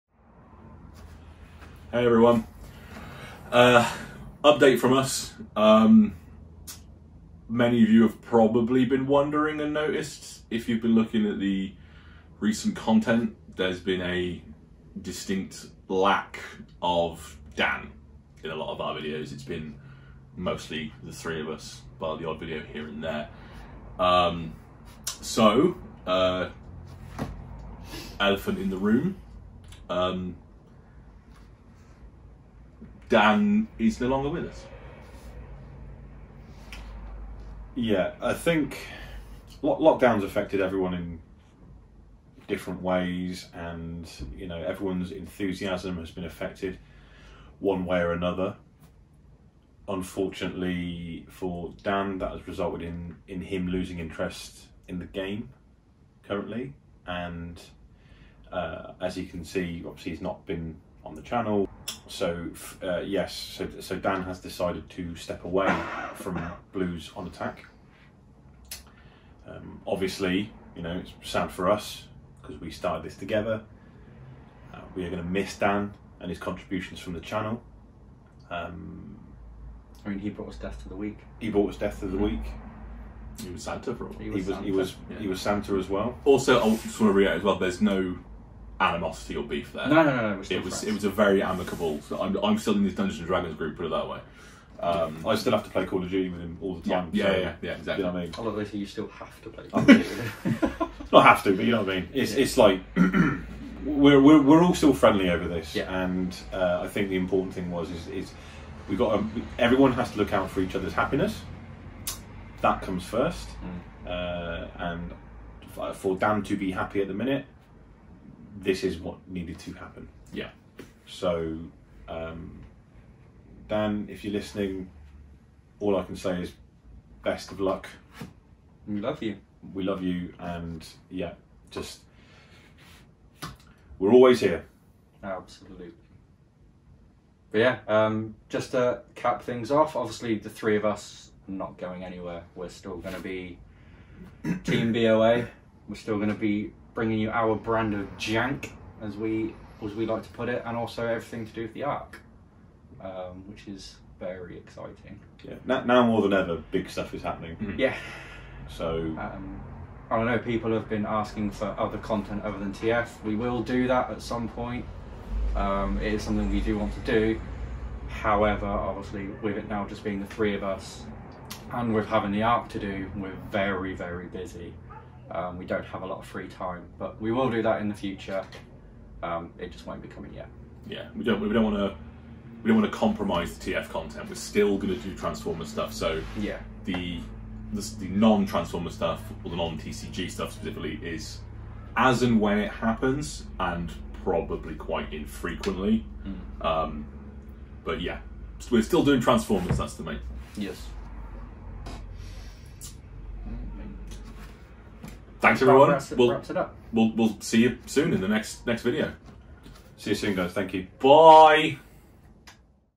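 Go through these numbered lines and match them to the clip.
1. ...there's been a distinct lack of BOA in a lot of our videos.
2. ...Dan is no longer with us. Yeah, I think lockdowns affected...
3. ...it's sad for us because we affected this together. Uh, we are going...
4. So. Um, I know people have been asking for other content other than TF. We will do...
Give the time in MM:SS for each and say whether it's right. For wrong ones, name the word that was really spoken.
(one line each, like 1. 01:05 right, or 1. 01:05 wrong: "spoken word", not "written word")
1. 00:13 wrong: "Dan", not "BOA"
2. 00:33 right
3. 01:11 wrong: "started", not "affected"
4. 02:38 right.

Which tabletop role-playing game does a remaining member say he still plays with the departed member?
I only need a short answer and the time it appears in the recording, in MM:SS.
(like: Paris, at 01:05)
Dungeons and Dragons, at 01:32.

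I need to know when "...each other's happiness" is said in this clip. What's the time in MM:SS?
01:50.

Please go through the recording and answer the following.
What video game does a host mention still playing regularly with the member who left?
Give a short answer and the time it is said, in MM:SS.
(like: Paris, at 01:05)
Call of Duty, at 01:35.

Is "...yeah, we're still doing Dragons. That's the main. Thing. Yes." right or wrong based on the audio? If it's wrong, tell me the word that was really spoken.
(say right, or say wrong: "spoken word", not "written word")
wrong: "Transformers", not "Dragons".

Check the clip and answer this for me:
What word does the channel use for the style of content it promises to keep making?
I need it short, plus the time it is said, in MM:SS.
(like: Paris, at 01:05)
jank, at 02:28.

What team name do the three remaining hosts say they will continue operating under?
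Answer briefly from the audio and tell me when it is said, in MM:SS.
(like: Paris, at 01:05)
Team BOA, at 02:24.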